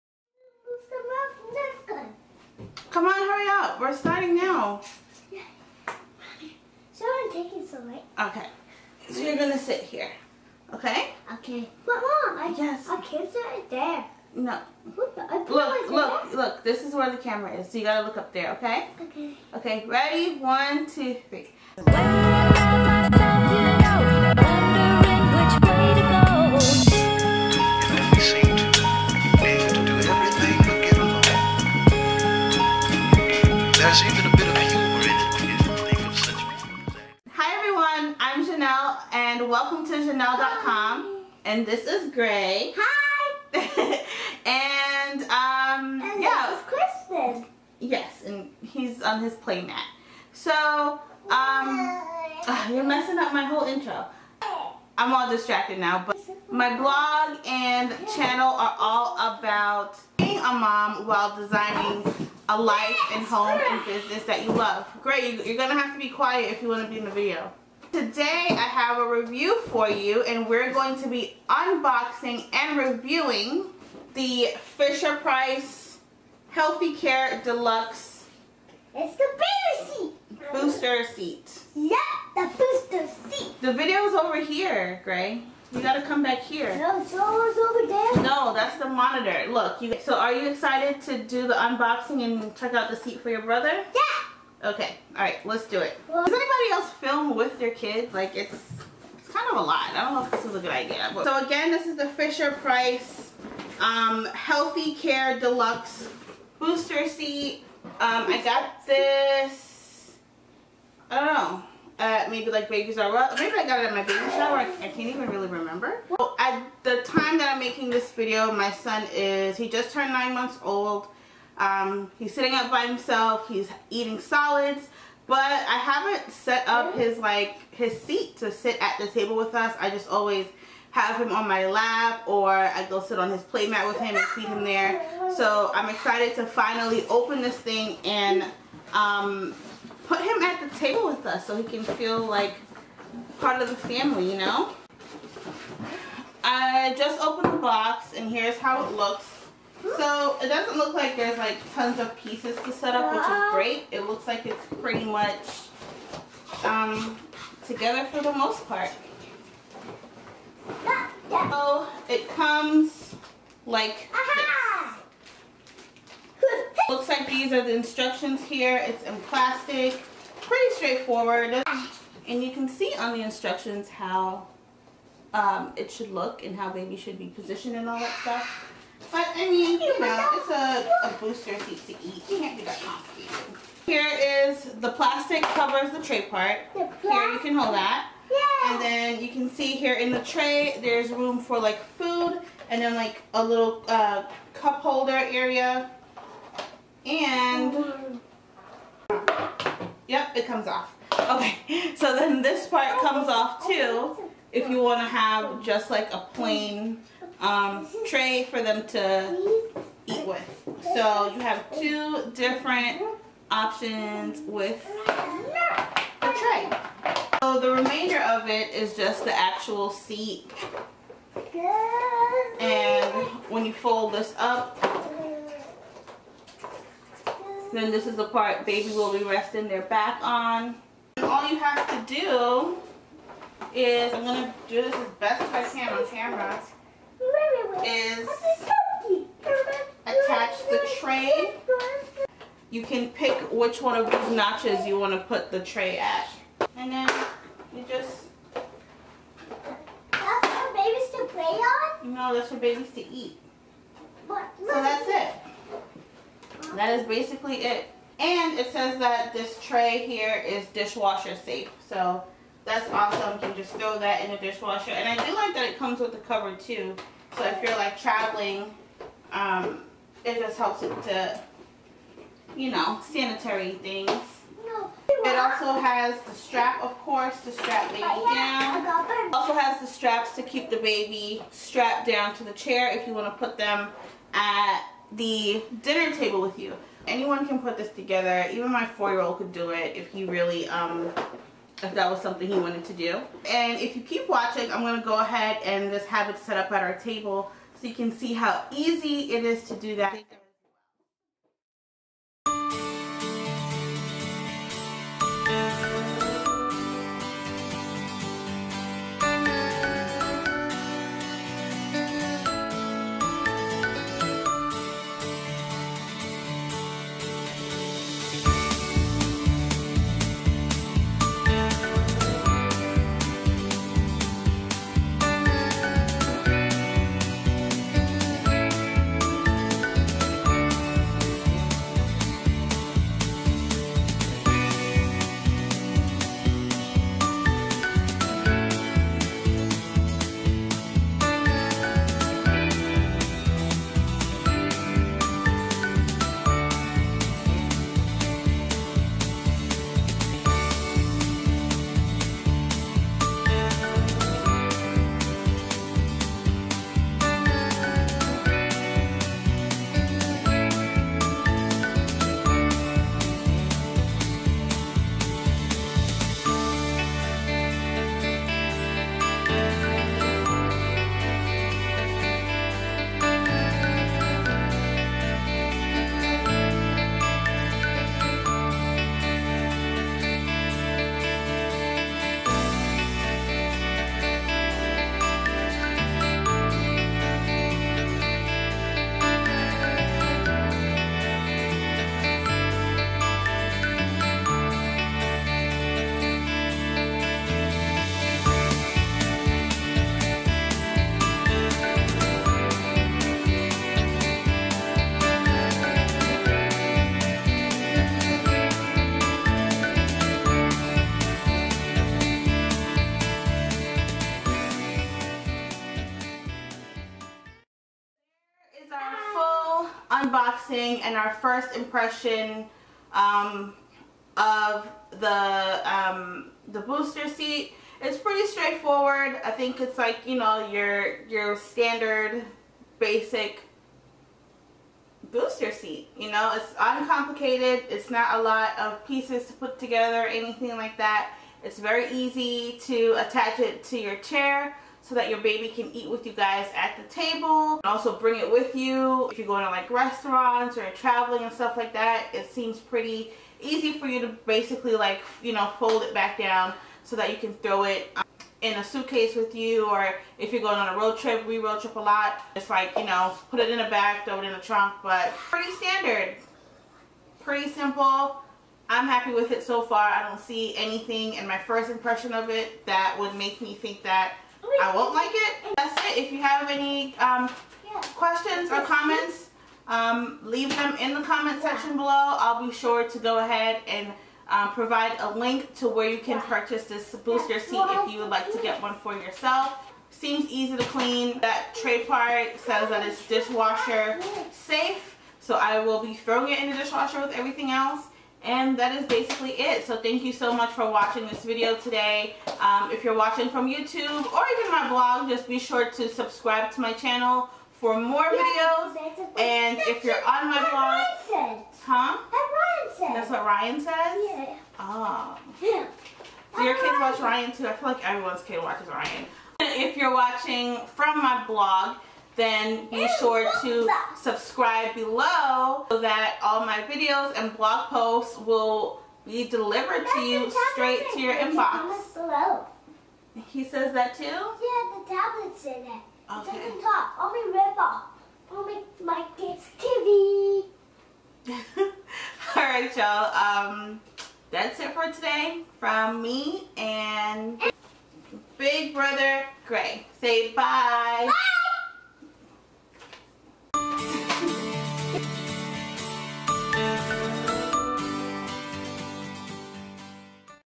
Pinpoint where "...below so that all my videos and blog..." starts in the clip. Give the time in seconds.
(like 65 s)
524 s.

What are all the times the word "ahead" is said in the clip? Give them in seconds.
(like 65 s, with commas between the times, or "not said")
295 s, 483 s.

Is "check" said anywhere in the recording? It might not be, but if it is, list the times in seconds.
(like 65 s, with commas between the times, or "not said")
92 s.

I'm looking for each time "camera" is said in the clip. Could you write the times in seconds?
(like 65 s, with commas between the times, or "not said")
17 s, 236 s.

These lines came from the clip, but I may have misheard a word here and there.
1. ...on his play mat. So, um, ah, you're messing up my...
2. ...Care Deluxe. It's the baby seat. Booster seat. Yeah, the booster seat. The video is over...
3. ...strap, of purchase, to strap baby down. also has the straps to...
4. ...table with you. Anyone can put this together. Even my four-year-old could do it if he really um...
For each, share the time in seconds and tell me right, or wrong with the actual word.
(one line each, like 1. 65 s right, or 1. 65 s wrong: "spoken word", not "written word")
1. 49 s right
2. 76 s right
3. 276 s wrong: "course", not "purchase"
4. 286 s right.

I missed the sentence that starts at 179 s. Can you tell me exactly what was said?
But I mean, you know, it's a, a booster seat to eat.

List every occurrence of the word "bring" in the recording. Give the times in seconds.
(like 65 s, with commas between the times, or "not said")
448 s.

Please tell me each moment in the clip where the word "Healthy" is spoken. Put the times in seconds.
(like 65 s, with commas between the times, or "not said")
76 s, 104 s.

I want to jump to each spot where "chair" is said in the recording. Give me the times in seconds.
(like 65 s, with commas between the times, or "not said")
282 s, 444 s.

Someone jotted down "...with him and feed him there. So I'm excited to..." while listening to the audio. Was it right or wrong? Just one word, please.
right.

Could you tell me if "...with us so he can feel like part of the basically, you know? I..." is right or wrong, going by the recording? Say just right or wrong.
wrong.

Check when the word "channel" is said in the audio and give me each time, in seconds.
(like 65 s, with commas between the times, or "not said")
58 s, 506 s.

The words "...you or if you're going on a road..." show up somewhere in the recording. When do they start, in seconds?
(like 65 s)
459 s.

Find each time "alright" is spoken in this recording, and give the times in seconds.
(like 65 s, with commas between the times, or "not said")
95 s, 542 s.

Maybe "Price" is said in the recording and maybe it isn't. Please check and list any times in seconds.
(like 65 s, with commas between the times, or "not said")
75 s, 102 s.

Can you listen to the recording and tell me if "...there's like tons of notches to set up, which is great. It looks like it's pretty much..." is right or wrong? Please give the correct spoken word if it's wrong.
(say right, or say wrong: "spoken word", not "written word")
wrong: "pieces", not "notches".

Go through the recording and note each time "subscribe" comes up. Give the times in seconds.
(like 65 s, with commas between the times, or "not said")
506 s, 524 s.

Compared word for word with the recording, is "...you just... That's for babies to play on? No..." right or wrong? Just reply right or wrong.
right.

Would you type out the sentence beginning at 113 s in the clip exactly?
Maybe I got it at my baby shower.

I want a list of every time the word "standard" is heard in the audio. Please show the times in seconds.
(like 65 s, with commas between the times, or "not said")
431 s, 465 s.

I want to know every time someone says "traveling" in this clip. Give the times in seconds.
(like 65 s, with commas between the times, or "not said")
267 s, 450 s.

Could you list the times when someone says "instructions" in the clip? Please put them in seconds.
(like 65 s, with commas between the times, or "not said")
167 s, 173 s.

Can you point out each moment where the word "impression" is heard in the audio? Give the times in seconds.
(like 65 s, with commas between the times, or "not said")
421 s, 471 s.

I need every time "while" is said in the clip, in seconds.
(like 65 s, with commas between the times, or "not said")
61 s.